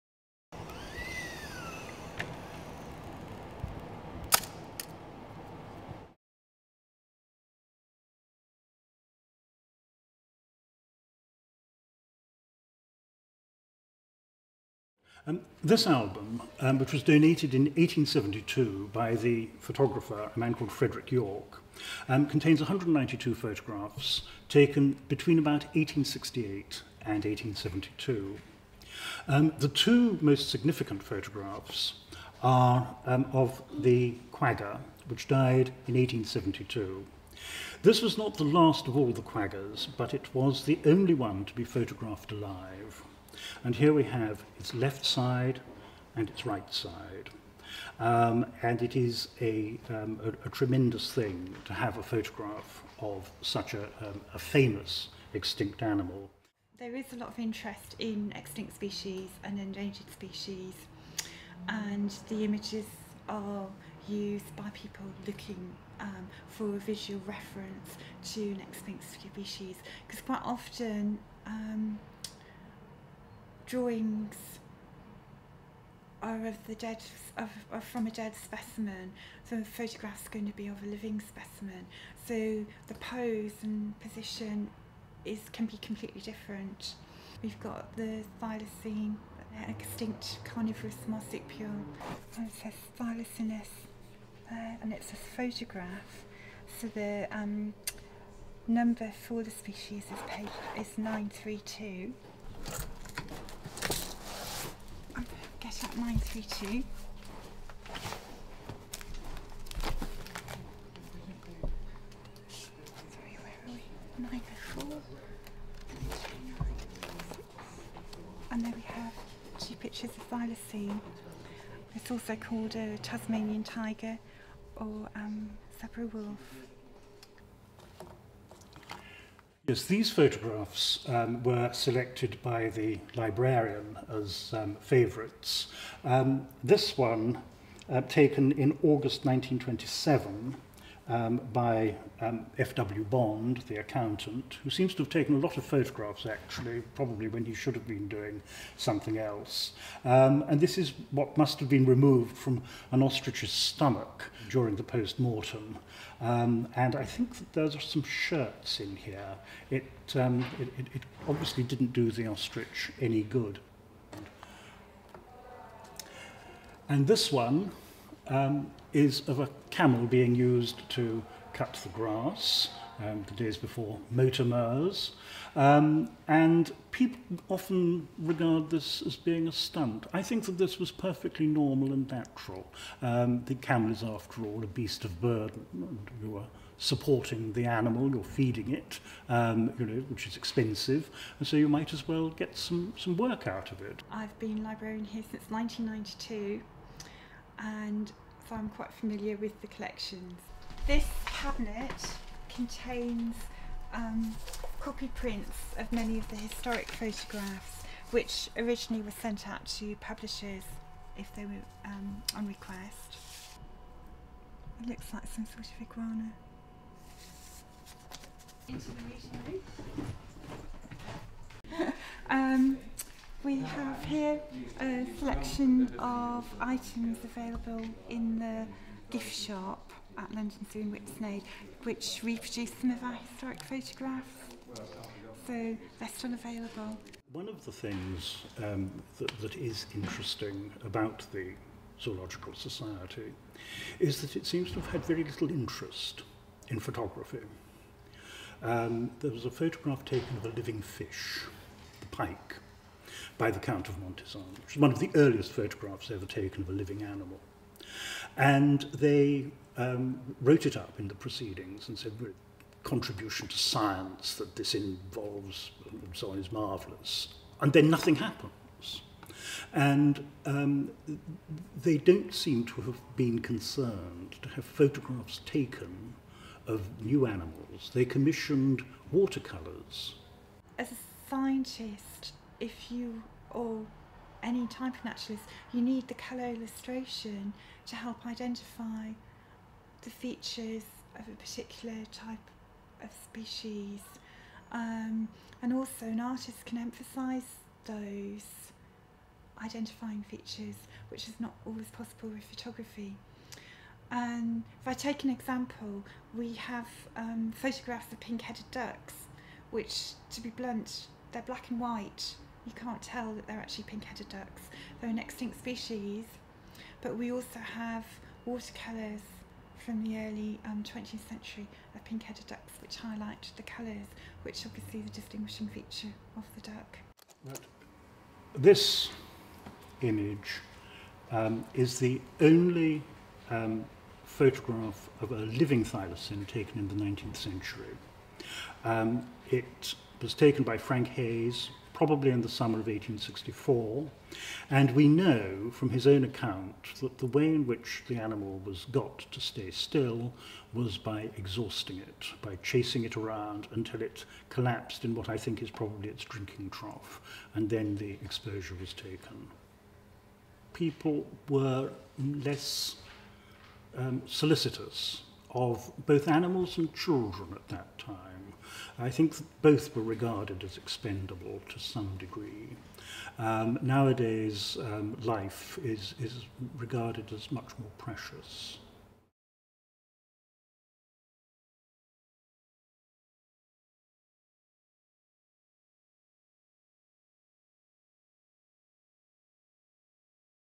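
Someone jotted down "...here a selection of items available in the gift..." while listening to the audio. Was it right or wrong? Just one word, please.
right.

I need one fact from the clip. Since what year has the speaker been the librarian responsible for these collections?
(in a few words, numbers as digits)
1992.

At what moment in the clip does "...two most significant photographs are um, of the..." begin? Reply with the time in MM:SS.
00:29.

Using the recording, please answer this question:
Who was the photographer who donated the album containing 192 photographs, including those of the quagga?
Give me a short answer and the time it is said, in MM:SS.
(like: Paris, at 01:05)
Frederick York, at 00:20.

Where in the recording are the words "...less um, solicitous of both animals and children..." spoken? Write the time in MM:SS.
06:02.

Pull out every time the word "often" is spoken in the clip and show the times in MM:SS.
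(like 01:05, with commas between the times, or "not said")
01:10, 02:57.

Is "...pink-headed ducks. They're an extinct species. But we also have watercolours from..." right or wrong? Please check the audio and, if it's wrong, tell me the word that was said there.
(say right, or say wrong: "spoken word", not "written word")
right.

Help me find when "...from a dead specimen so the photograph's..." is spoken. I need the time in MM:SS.
01:17.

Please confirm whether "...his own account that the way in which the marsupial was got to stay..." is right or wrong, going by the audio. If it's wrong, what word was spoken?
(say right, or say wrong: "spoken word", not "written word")
wrong: "animal", not "marsupial".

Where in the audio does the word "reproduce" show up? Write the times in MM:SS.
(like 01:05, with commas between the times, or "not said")
03:52.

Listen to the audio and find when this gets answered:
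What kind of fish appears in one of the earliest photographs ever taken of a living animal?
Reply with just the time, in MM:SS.
04:12.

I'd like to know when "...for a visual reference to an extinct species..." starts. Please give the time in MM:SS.
01:06.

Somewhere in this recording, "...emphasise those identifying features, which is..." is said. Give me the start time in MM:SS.
04:56.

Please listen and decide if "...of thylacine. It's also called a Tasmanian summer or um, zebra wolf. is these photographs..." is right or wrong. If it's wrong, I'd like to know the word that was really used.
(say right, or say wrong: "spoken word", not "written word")
wrong: "tiger", not "summer".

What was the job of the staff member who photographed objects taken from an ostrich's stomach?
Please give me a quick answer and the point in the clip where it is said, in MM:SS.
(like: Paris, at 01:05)
accountant, at 02:23.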